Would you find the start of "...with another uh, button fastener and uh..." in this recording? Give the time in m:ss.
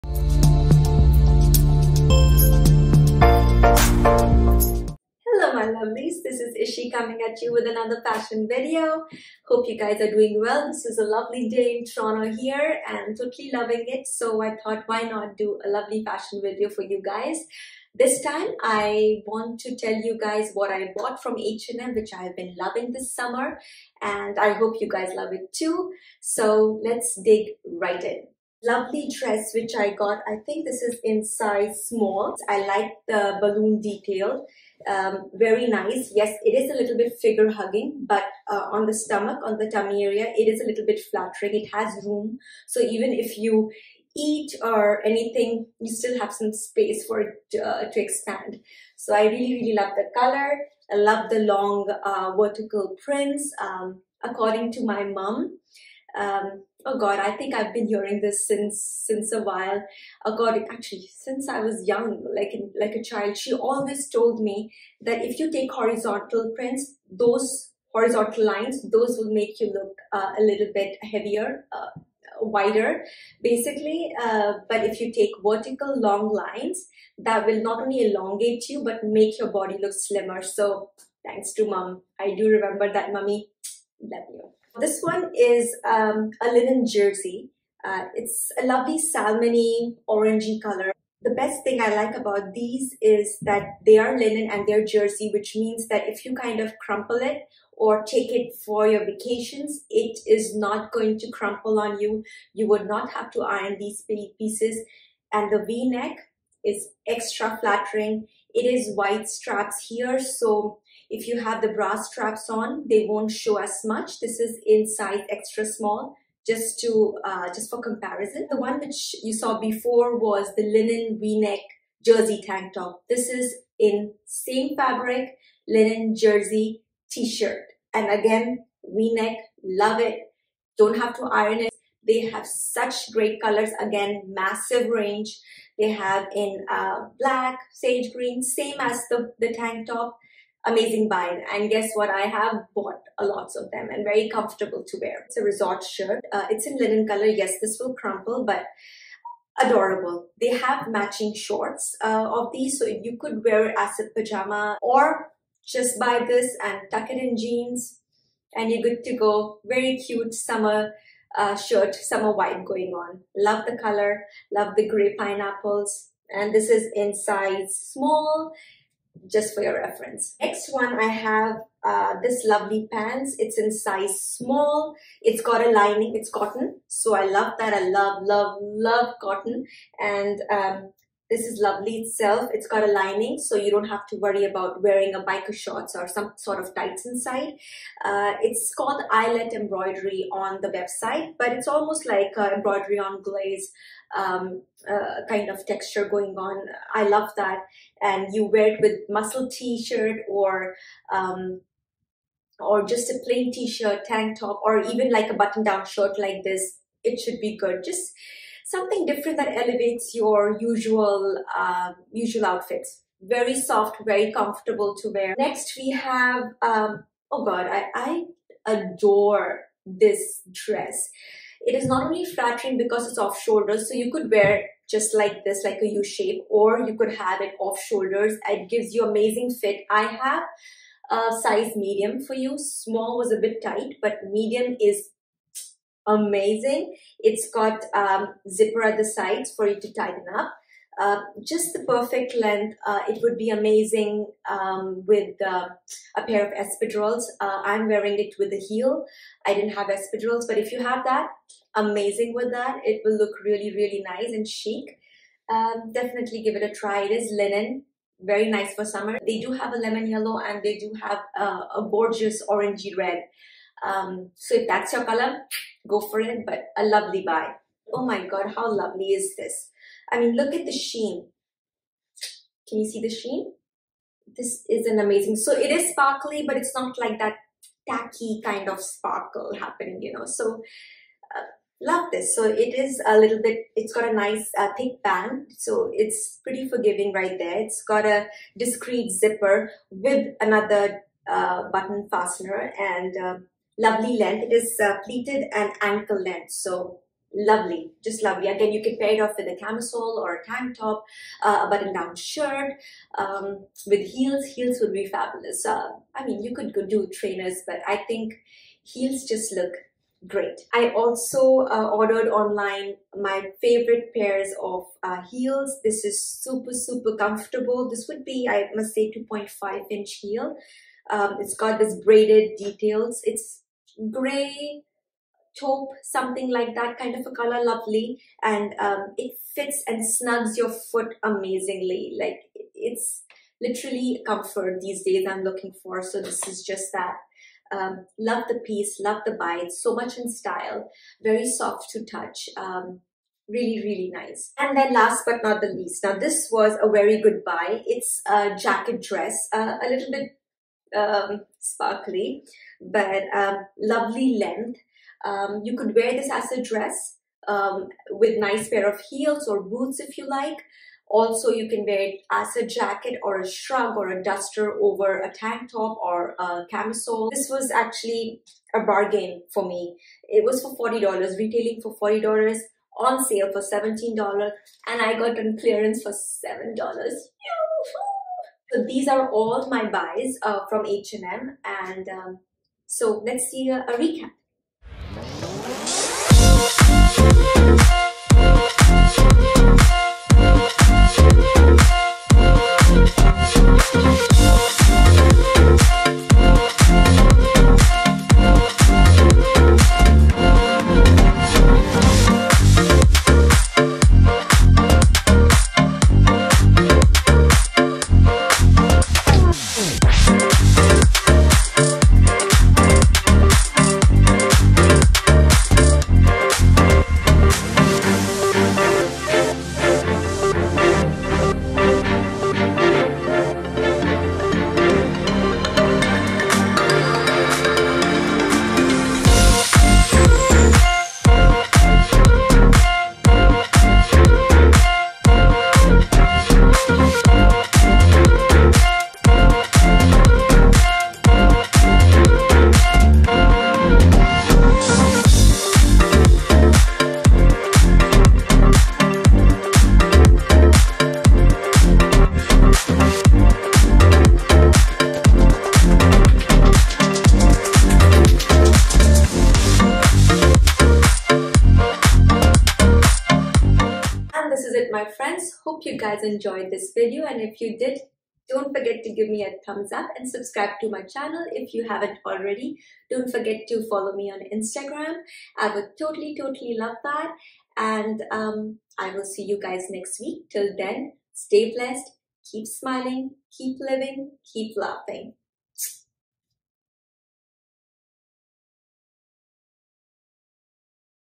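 4:49.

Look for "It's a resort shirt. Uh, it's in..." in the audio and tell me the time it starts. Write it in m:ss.
2:25.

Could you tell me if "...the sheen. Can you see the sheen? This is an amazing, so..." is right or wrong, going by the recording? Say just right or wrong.
right.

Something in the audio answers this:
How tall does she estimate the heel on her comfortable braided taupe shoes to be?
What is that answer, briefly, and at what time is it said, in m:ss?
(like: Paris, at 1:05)
2.5 inches, at 5:19.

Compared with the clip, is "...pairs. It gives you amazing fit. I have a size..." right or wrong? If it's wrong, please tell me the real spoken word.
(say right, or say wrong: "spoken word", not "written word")
wrong: "shoulders", not "pairs".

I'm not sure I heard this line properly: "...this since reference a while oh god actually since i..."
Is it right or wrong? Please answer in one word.
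wrong.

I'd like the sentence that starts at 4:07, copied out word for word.
Uh, I'm wearing it with a heel.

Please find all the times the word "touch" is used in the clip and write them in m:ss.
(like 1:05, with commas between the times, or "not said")
5:42.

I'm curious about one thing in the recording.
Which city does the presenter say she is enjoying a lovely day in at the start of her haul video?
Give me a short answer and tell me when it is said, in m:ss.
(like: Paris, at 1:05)
Toronto, at 0:11.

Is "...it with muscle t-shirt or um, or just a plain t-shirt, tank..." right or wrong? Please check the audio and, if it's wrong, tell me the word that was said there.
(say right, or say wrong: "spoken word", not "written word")
right.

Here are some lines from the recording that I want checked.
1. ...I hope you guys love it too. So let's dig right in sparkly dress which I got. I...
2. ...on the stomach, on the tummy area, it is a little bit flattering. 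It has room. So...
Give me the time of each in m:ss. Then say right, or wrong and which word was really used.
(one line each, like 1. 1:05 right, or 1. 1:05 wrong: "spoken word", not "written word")
1. 0:24 wrong: "lovely", not "sparkly"
2. 0:38 right.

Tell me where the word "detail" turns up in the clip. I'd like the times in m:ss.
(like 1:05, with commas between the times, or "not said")
0:33, 5:22.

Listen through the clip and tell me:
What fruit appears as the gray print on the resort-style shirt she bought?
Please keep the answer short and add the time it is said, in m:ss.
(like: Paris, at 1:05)
Pineapples, at 2:45.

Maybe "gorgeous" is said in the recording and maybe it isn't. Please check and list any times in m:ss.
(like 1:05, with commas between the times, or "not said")
4:21.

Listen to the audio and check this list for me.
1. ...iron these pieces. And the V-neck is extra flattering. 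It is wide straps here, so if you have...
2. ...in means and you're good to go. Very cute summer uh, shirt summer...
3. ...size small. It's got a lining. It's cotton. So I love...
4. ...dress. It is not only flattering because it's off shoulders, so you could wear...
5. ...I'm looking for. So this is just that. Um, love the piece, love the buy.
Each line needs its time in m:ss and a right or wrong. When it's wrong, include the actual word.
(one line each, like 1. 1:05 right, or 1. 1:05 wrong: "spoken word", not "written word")
1. 1:43 right
2. 2:37 wrong: "jeans", not "means"
3. 2:53 right
4. 3:40 right
5. 5:35 right.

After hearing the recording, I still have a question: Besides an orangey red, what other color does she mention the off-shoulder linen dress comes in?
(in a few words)
Lemon yellow.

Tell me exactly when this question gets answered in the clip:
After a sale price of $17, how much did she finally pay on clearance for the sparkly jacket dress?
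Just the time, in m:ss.
6:16.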